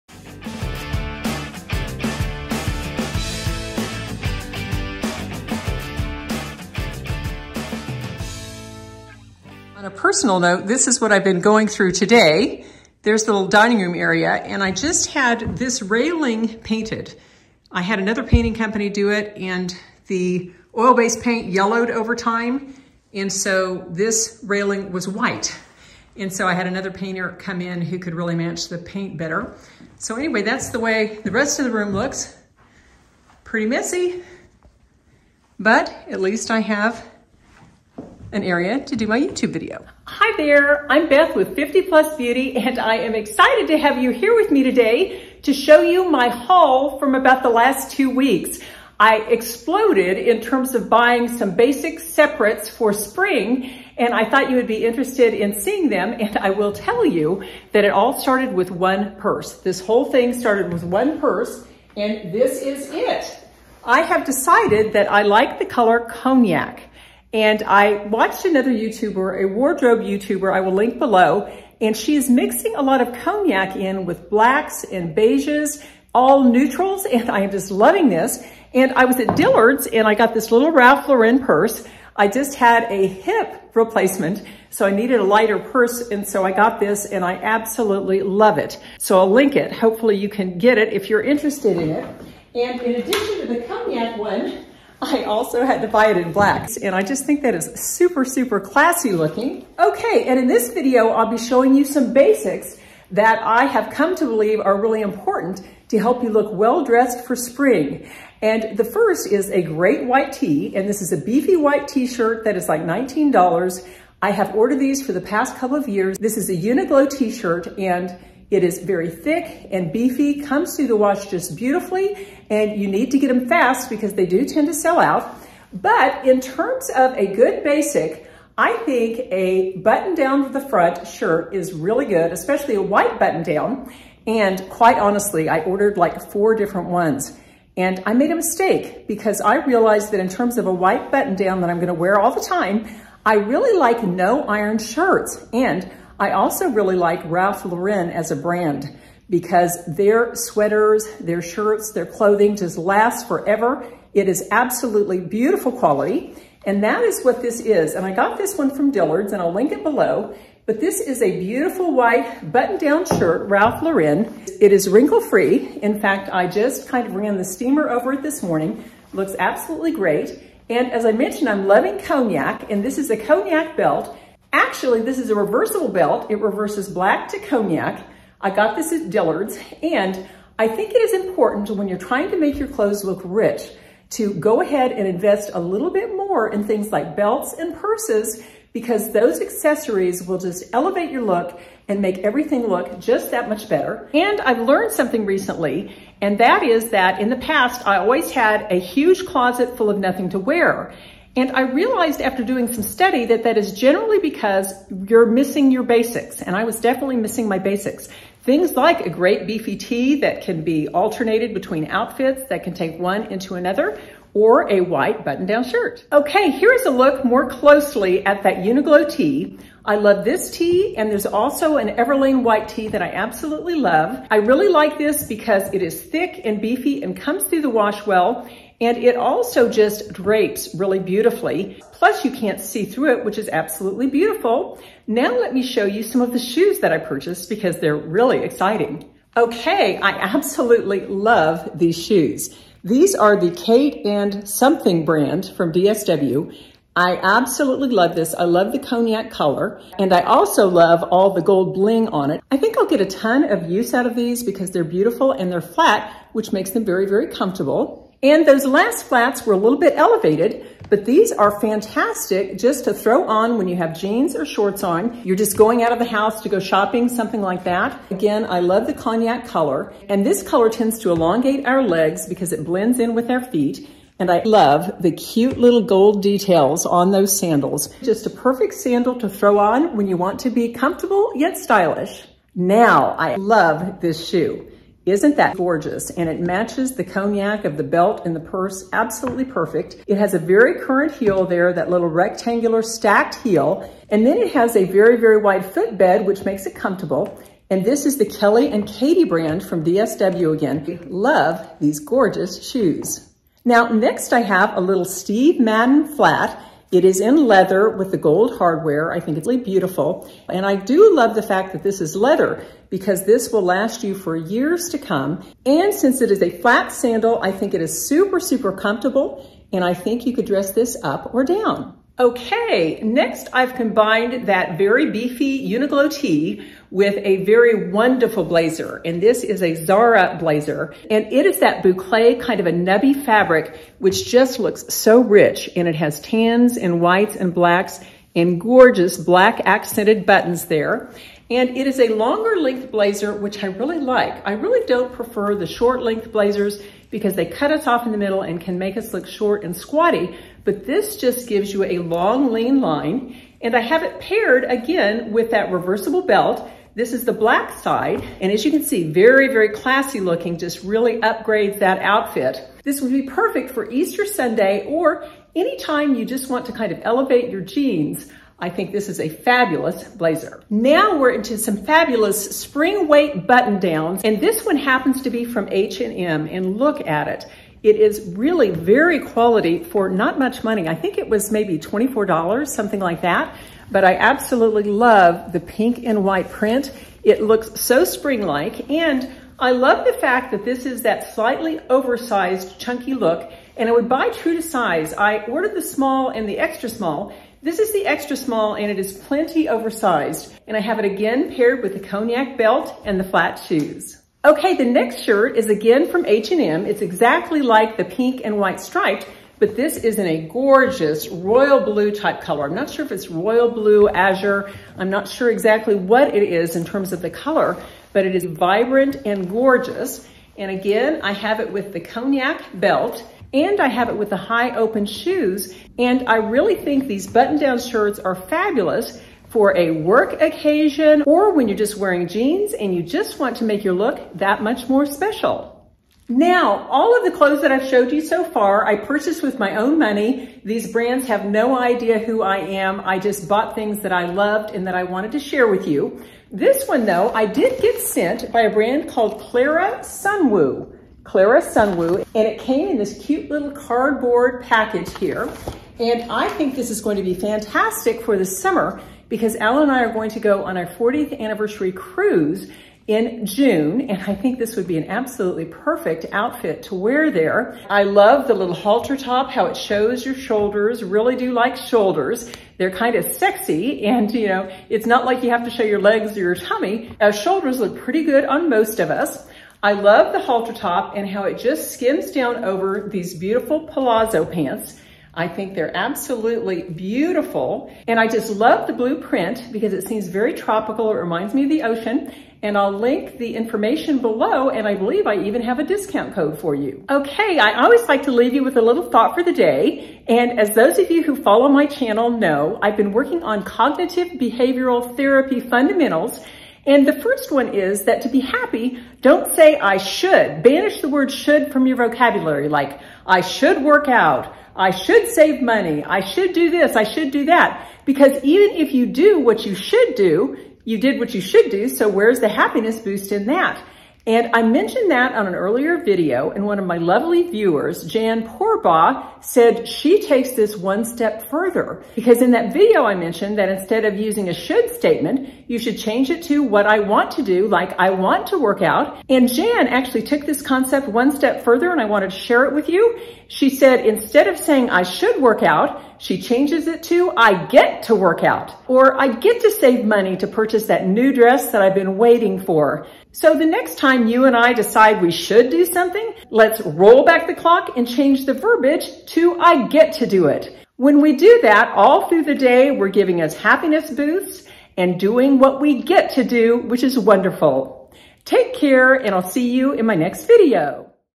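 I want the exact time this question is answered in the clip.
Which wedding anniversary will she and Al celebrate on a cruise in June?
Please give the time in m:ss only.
7:40.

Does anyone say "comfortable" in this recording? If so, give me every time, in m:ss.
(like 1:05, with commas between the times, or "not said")
4:17, 4:40, 4:56, 5:18.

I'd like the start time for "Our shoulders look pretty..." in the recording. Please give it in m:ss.
7:57.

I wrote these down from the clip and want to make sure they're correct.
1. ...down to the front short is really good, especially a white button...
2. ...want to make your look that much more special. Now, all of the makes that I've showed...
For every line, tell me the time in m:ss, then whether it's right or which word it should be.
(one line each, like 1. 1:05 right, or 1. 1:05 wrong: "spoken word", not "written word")
1. 2:10 wrong: "shirt", not "short"
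2. 7:13 wrong: "clothes", not "makes".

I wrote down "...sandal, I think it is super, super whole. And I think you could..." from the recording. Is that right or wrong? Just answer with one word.
wrong.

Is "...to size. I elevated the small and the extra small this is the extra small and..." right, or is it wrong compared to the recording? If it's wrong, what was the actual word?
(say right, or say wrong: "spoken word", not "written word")
wrong: "ordered", not "elevated".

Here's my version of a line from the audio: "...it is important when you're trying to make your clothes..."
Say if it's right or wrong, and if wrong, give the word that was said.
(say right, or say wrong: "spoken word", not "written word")
right.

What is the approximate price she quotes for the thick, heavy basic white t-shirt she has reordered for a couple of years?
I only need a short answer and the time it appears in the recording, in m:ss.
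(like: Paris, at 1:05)
$19, at 1:52.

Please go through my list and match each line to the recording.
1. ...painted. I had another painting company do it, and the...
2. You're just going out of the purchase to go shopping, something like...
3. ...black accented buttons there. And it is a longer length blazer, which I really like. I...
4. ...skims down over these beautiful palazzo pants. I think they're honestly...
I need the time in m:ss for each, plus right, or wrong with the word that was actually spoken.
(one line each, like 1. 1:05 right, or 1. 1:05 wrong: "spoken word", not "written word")
1. 0:16 right
2. 4:25 wrong: "house", not "purchase"
3. 5:39 right
4. 8:01 wrong: "absolutely", not "honestly".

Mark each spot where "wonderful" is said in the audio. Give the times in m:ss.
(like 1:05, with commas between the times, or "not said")
5:27, 9:27.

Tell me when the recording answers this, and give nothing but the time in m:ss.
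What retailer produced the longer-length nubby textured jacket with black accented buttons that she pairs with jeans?
5:29.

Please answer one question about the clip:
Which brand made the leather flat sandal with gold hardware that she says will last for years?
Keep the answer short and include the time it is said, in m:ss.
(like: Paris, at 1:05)
Steve Madden, at 5:05.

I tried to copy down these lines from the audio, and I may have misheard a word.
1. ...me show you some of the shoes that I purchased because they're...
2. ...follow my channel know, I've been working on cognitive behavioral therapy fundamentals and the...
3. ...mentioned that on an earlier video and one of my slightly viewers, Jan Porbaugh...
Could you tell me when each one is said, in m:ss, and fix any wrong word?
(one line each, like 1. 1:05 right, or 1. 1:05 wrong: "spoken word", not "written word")
1. 3:55 right
2. 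8:21 right
3. 8:44 wrong: "lovely", not "slightly".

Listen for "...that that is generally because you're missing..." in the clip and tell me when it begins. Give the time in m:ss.
3:23.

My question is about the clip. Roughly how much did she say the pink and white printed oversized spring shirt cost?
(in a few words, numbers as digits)
$24.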